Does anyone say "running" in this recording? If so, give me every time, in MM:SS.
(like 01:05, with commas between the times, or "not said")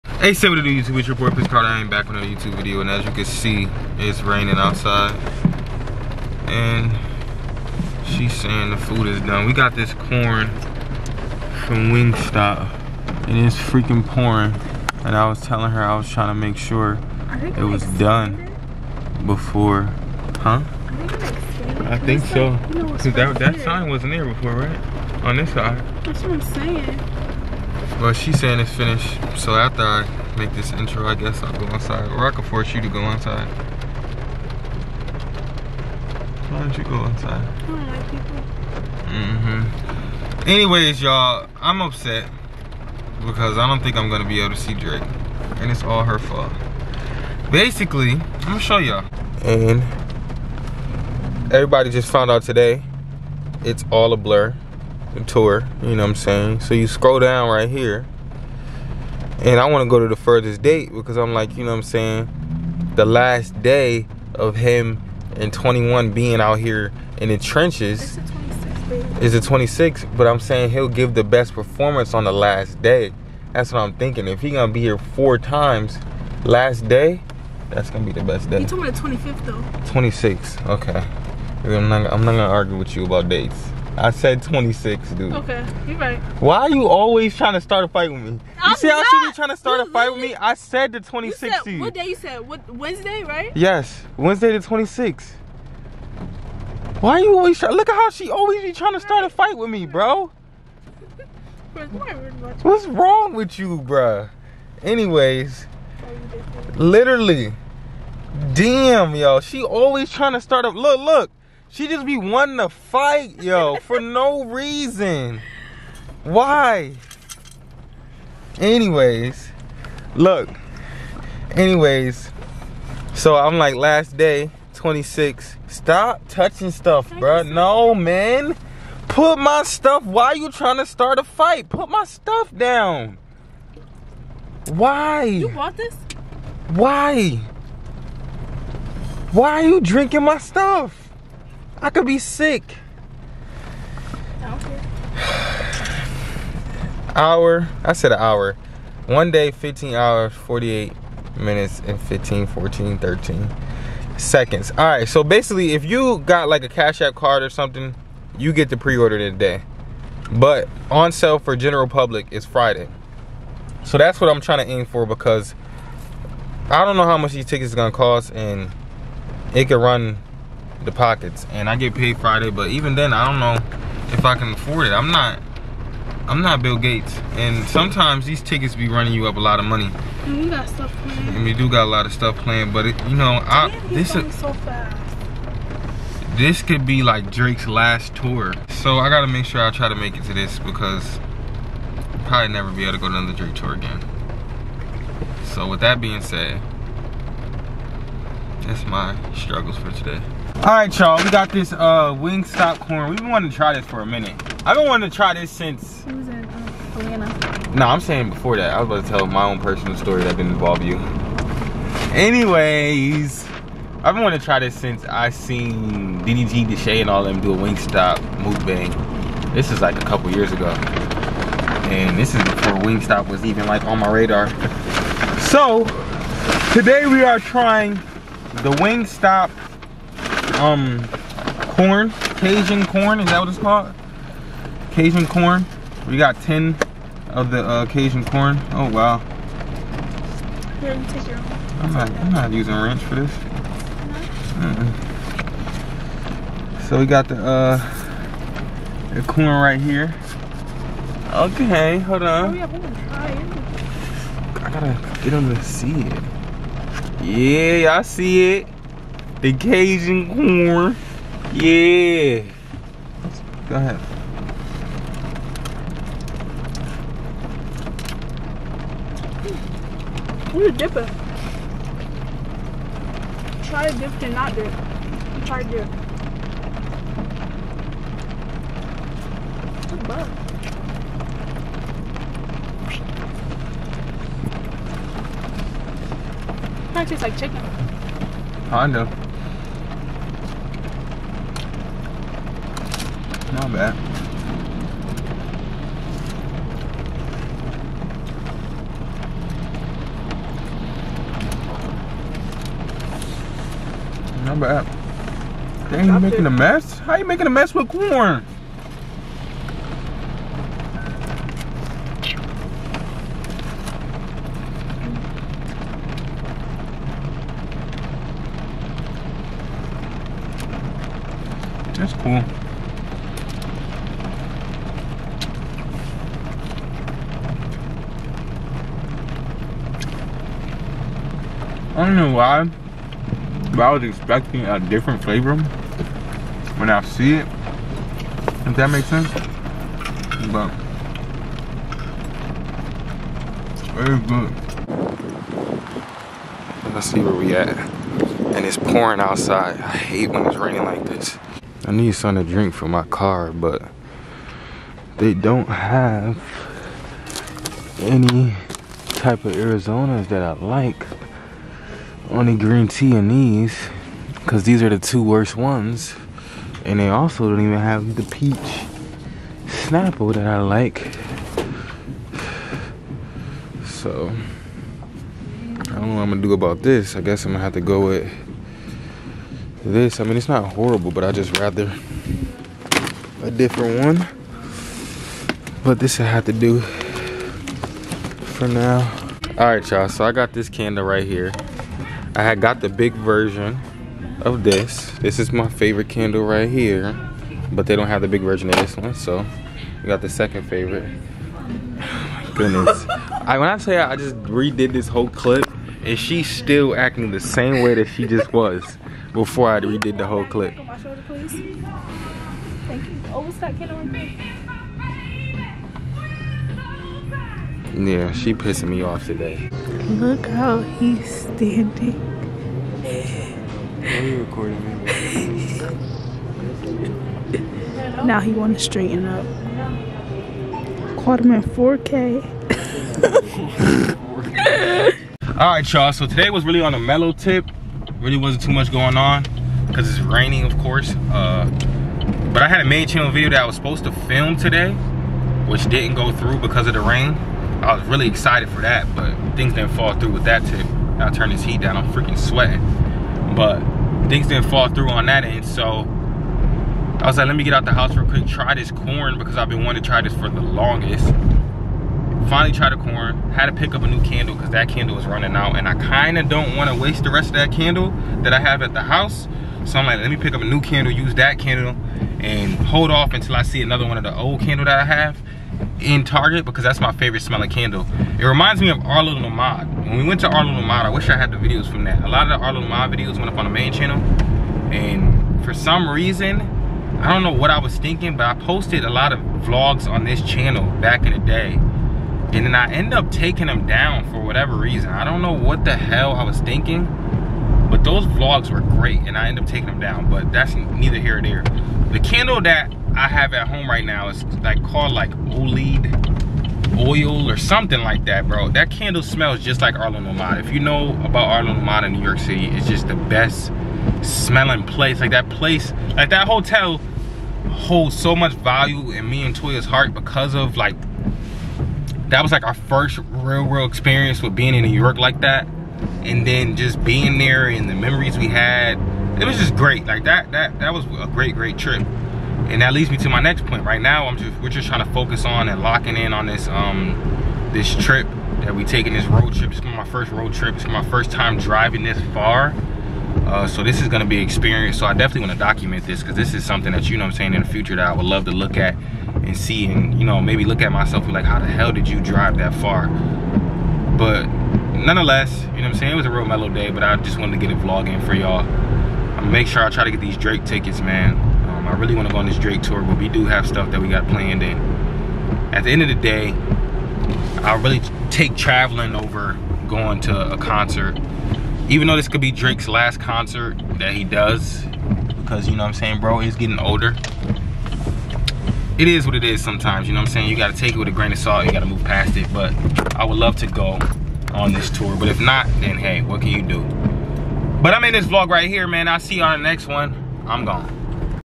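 02:58, 07:45.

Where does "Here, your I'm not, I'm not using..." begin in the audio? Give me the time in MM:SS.
04:00.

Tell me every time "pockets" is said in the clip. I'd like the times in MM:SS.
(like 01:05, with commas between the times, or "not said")
02:50.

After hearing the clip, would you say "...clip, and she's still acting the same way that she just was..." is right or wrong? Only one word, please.
right.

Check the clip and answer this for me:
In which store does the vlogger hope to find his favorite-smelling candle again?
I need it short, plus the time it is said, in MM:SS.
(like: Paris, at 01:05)
Target, at 07:56.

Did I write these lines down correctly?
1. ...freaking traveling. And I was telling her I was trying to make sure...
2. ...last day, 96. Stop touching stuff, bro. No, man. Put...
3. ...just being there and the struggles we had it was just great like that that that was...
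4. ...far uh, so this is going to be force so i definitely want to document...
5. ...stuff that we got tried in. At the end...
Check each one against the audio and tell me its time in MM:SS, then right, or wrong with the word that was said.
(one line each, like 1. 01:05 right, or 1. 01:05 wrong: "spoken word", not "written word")
1. 00:13 wrong: "pouring", not "traveling"
2. 02:03 wrong: "26", not "96"
3. 08:46 wrong: "memories", not "struggles"
4. 09:02 wrong: "experience", not "force"
5. 09:23 wrong: "planned", not "tried".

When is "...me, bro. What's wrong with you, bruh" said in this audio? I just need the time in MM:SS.
01:39.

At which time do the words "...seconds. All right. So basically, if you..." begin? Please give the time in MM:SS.
02:34.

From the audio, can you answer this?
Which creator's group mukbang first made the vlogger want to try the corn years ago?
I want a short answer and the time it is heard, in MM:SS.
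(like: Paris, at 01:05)
DDG, at 03:36.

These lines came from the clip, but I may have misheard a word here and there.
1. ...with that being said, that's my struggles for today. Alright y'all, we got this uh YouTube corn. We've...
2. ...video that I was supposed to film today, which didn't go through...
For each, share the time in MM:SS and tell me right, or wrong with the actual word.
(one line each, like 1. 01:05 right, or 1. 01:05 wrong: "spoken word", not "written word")
1. 03:15 wrong: "Wingstop", not "YouTube"
2. 07:23 right.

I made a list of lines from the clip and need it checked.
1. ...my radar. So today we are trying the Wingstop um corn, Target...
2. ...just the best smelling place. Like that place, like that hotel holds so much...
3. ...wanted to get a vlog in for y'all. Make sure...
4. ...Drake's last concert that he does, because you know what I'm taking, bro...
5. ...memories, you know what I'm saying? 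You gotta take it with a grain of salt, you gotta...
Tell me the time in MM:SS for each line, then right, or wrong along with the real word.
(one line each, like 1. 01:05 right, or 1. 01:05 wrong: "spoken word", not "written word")
1. 03:43 wrong: "Cajun", not "Target"
2. 08:32 right
3. 09:17 right
4. 09:32 wrong: "saying", not "taking"
5. 09:39 wrong: "sometimes", not "memories".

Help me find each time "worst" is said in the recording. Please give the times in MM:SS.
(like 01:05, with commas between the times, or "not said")
06:05.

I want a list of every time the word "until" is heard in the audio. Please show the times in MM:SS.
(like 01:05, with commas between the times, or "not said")
07:53.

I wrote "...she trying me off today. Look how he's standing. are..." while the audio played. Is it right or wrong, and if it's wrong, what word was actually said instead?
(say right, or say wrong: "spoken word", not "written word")
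wrong: "pissing", not "trying".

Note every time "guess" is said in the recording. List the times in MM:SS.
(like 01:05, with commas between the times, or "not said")
00:31, 06:17.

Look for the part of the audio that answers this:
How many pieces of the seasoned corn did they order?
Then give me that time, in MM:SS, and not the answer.
03:56.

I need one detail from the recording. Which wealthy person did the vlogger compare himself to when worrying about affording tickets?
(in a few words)
Bill Gates.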